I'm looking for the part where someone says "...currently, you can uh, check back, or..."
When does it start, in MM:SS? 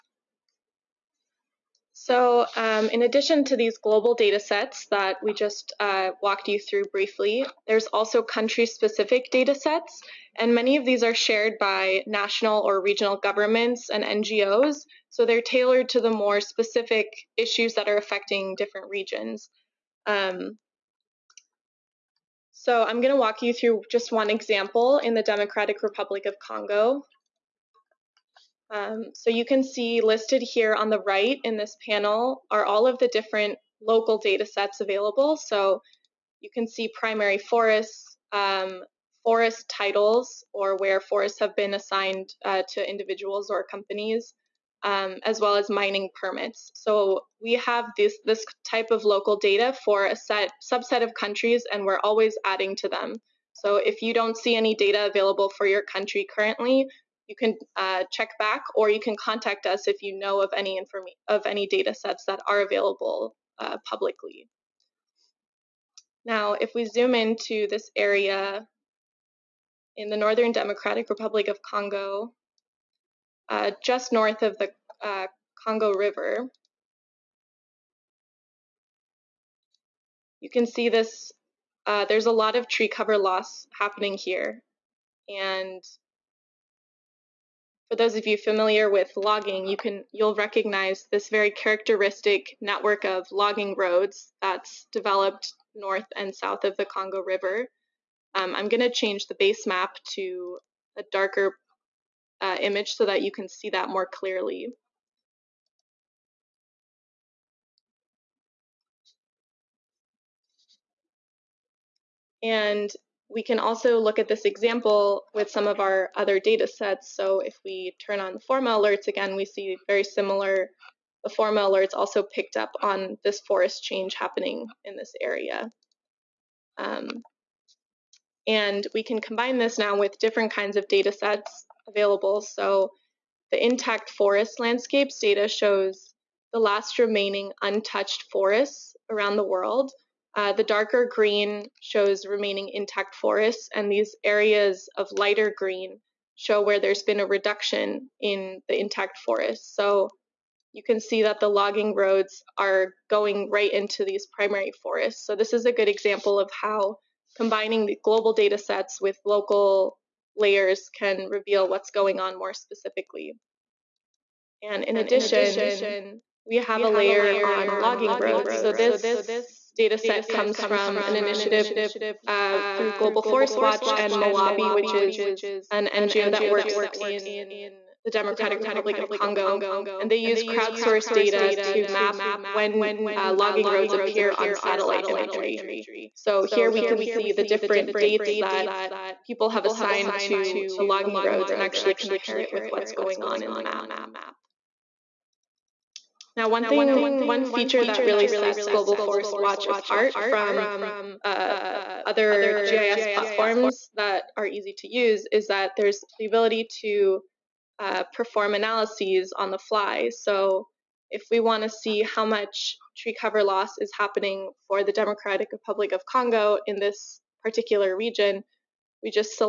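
00:56.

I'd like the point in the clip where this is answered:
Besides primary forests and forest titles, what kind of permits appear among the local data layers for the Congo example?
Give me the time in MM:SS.
00:45.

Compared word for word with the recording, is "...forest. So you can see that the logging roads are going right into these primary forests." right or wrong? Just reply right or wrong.
right.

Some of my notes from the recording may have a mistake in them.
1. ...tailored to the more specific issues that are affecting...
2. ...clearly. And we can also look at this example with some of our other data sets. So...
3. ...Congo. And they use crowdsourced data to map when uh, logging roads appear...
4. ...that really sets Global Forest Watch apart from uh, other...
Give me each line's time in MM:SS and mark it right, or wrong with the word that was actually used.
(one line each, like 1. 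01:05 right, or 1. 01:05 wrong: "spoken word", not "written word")
1. 00:15 right
2. 01:44 right
3. 02:59 right
4. 03:17 right.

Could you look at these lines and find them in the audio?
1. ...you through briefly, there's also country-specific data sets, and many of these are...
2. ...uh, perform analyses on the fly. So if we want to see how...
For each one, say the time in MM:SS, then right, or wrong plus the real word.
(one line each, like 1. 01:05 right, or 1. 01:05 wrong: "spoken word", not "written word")
1. 00:06 right
2. 03:27 right.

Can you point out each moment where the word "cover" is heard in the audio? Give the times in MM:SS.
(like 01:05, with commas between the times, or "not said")
01:22, 03:33.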